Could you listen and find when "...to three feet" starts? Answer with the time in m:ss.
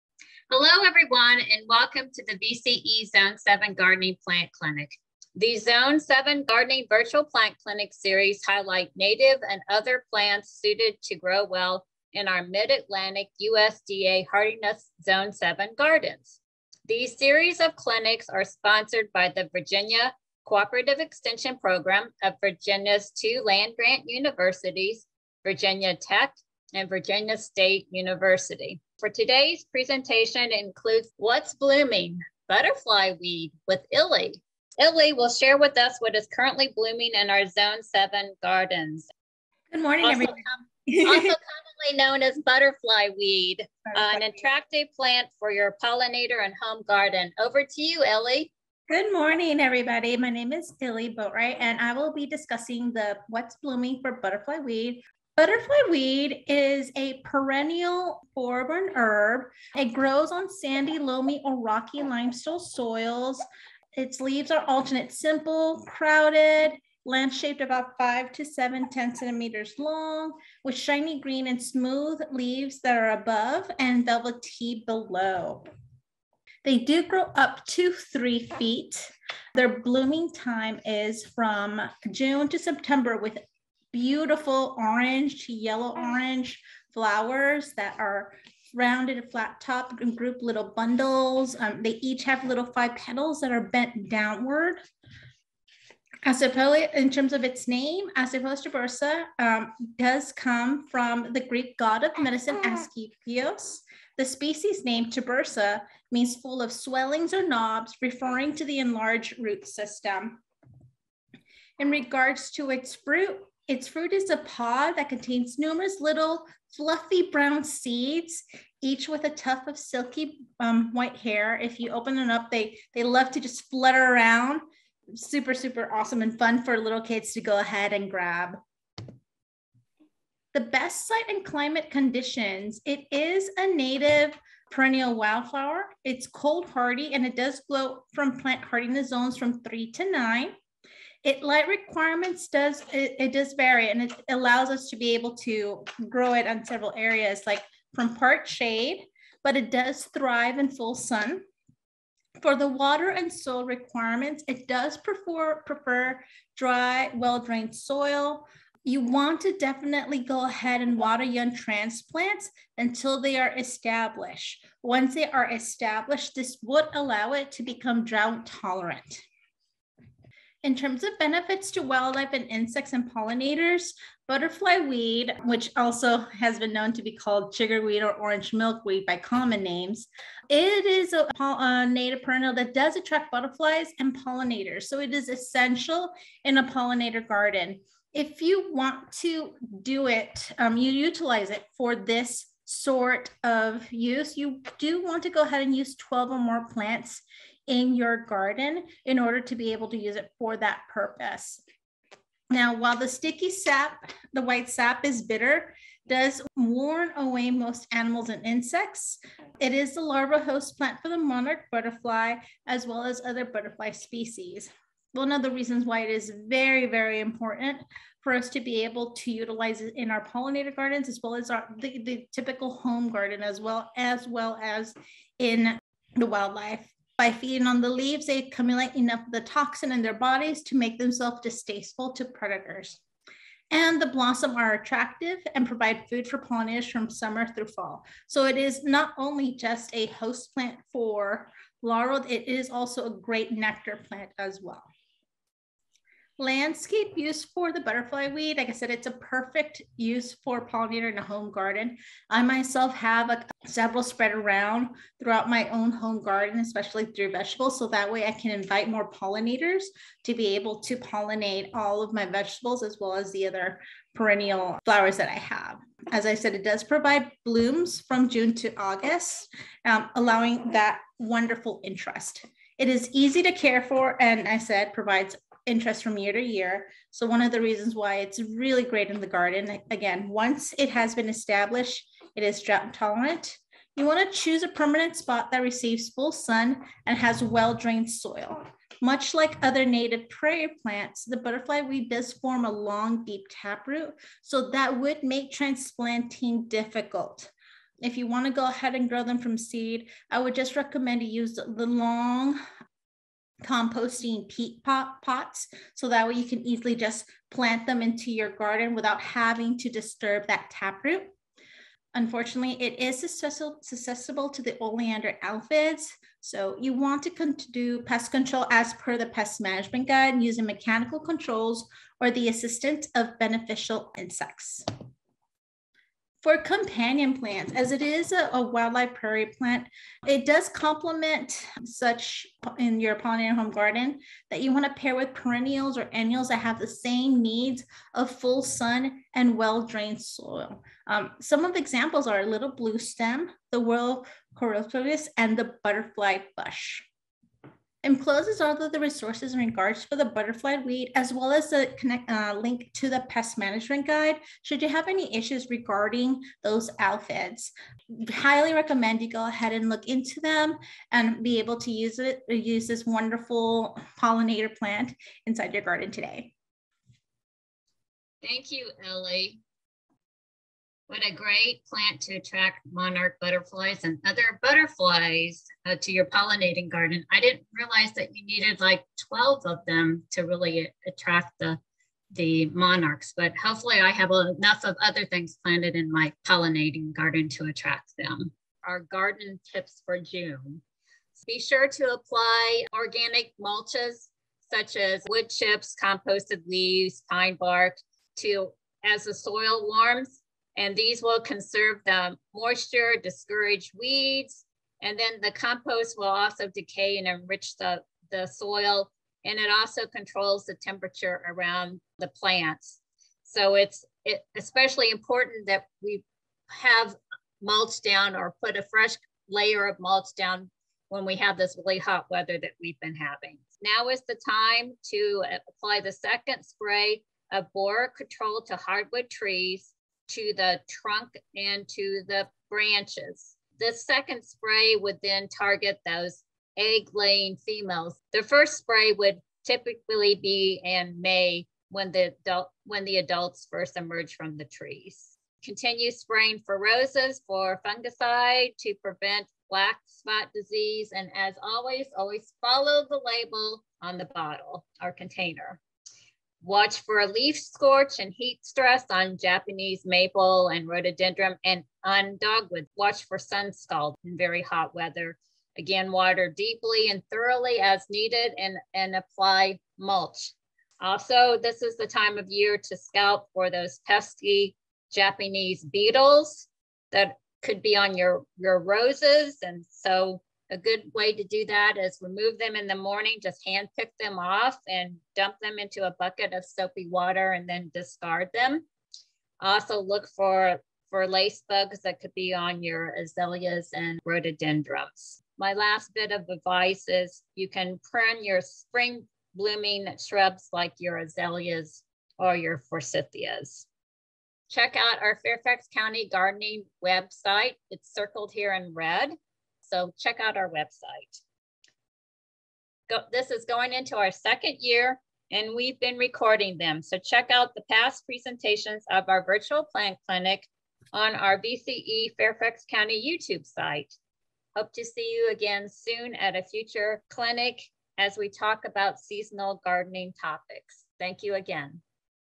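1:17.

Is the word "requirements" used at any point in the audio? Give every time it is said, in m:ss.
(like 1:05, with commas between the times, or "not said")
2:21, 2:33.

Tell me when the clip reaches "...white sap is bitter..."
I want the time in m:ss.
3:24.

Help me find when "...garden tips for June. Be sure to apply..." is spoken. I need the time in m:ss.
6:29.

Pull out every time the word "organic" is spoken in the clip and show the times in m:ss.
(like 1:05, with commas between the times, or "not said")
6:32.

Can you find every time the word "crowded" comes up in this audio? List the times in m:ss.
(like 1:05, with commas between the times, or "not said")
1:05.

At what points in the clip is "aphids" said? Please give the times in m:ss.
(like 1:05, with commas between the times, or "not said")
5:15, 5:56.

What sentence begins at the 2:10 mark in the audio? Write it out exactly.
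The best site and climate conditions.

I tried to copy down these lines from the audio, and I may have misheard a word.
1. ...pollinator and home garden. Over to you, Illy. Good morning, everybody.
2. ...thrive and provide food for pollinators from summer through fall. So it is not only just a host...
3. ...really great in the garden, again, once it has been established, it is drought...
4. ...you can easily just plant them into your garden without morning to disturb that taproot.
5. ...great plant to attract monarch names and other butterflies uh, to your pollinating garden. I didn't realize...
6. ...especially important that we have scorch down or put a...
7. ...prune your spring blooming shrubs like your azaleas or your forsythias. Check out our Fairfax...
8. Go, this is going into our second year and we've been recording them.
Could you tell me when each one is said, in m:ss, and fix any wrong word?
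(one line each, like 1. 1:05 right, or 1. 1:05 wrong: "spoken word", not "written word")
1. 0:45 right
2. 3:54 wrong: "attractive", not "thrive"
3. 4:38 right
4. 5:06 wrong: "having", not "morning"
5. 6:11 wrong: "butterflies", not "names"
6. 6:54 wrong: "mulch", not "scorch"
7. 8:18 right
8. 8:33 right.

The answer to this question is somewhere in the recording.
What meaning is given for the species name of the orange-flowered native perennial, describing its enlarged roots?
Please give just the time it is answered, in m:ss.
1:46.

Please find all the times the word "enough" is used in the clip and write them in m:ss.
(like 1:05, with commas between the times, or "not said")
3:48, 6:24.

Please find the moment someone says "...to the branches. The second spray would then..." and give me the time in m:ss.
7:11.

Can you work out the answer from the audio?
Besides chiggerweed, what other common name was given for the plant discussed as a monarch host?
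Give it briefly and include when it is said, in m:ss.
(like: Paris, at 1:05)
Orange milkweed, at 2:58.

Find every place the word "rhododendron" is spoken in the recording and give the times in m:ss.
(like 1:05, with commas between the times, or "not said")
7:40, 8:14.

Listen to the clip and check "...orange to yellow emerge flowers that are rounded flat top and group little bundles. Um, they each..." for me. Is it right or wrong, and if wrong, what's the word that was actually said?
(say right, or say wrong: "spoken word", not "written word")
wrong: "orange", not "emerge".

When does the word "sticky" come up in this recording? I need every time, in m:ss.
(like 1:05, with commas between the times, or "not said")
3:23.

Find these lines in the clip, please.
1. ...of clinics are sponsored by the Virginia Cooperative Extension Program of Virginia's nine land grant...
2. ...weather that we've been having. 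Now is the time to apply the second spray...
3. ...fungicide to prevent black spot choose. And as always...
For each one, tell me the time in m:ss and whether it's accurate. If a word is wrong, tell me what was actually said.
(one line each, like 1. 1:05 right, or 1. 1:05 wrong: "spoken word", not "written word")
1. 0:17 wrong: "two", not "nine"
2. 7:02 right
3. 7:27 wrong: "disease", not "choose".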